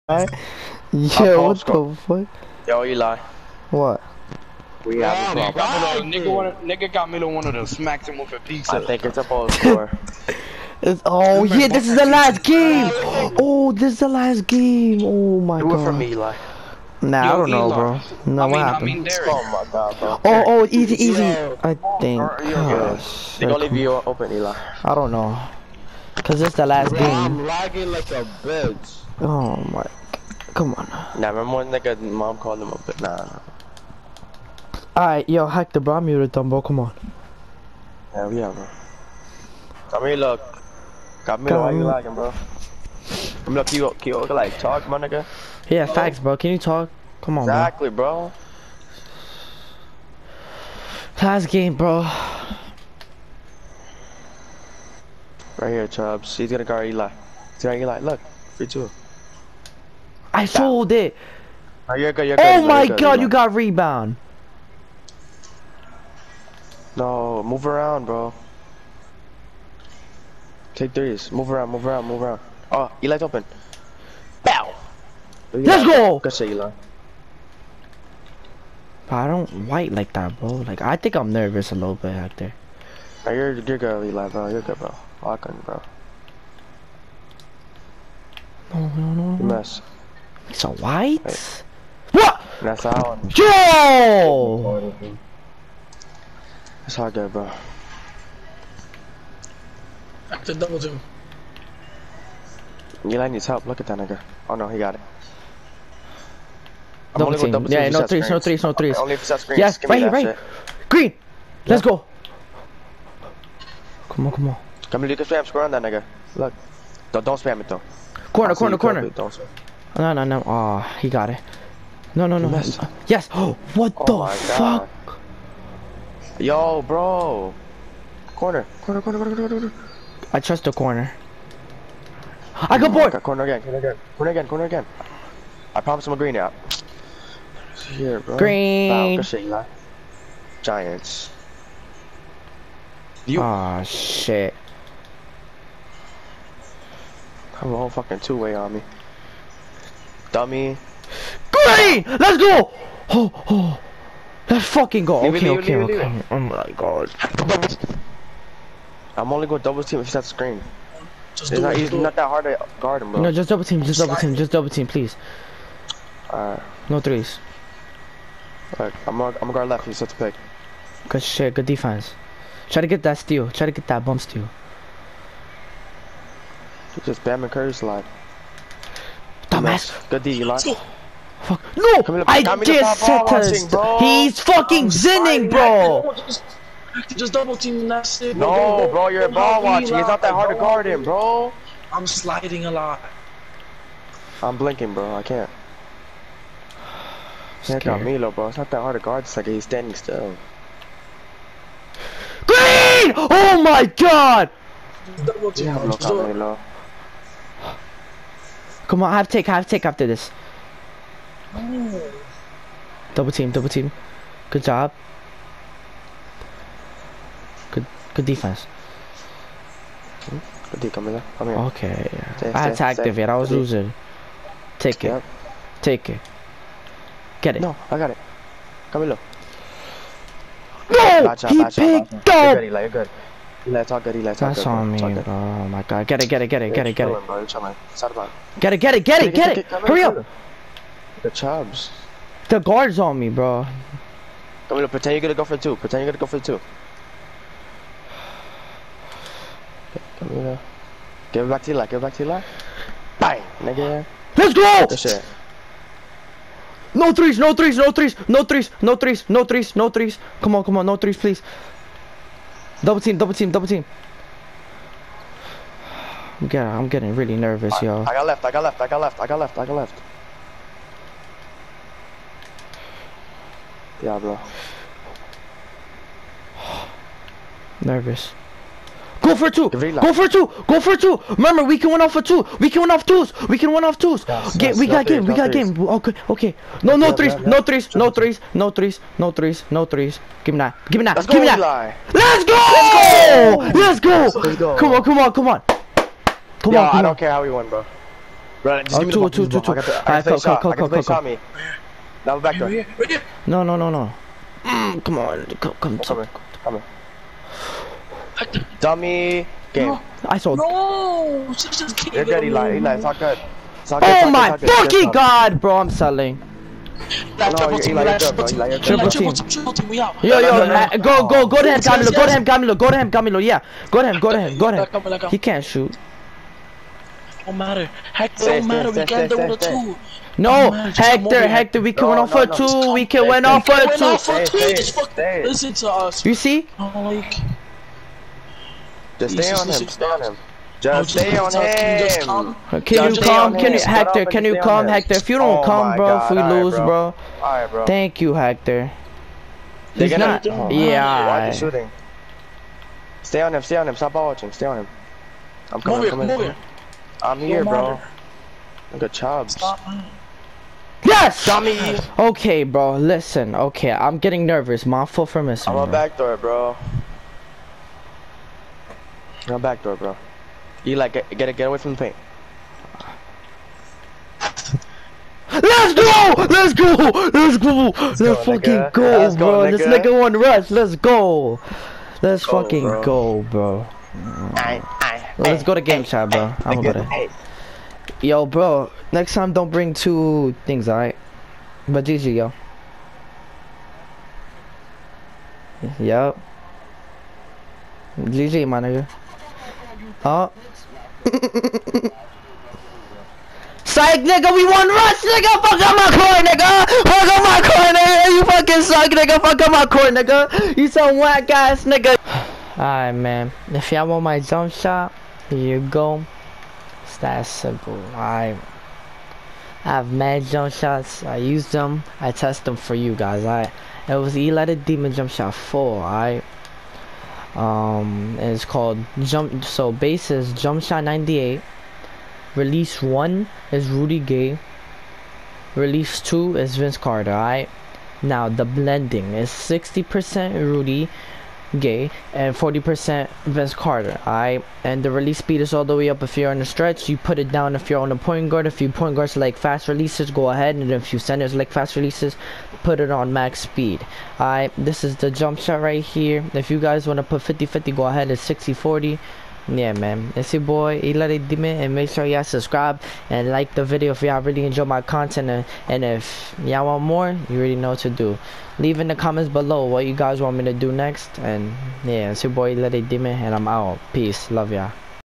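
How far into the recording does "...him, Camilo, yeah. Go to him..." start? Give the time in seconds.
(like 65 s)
322 s.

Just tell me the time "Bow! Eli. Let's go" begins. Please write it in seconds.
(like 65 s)
74 s.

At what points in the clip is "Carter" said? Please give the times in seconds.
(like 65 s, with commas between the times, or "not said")
436 s, 443 s.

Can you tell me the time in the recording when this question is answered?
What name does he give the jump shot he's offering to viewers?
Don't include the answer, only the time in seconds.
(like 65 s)
424 s.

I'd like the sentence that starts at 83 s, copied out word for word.
Right, you're, you're good, Eli, bro.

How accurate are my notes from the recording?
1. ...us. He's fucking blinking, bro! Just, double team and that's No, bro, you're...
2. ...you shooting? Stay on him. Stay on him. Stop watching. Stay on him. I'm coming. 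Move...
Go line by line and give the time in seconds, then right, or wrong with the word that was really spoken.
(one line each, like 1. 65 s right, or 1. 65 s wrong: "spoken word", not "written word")
1. 183 s wrong: "zinning", not "blinking"
2. 351 s right.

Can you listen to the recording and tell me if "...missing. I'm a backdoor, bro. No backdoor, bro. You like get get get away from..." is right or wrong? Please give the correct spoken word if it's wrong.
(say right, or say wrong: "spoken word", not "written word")
right.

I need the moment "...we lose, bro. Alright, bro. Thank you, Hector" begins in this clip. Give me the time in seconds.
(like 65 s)
346 s.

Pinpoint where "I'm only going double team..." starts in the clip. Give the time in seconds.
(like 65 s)
159 s.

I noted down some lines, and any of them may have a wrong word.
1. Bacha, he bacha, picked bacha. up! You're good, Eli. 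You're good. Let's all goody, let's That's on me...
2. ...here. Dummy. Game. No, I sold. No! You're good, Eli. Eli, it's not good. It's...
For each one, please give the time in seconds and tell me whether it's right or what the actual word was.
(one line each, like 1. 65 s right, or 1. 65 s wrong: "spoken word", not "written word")
1. 231 s right
2. 306 s right.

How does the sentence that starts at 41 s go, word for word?
Come here, why you lagging, bro?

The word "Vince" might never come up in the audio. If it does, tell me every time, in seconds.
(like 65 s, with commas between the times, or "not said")
436 s, 443 s.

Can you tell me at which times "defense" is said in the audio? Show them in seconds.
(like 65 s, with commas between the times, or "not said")
171 s, 218 s.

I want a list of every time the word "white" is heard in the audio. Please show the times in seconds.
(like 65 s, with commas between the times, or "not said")
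79 s, 90 s.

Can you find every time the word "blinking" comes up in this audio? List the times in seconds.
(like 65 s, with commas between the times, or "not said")
194 s.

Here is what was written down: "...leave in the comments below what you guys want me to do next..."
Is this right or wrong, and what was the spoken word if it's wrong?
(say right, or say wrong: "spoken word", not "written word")
right.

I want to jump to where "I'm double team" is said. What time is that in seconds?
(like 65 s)
107 s.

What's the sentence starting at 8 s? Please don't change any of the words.
I think it's a ball score.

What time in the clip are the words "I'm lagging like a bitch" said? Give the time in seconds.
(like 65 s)
27 s.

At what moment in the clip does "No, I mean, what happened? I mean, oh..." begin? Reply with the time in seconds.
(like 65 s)
17 s.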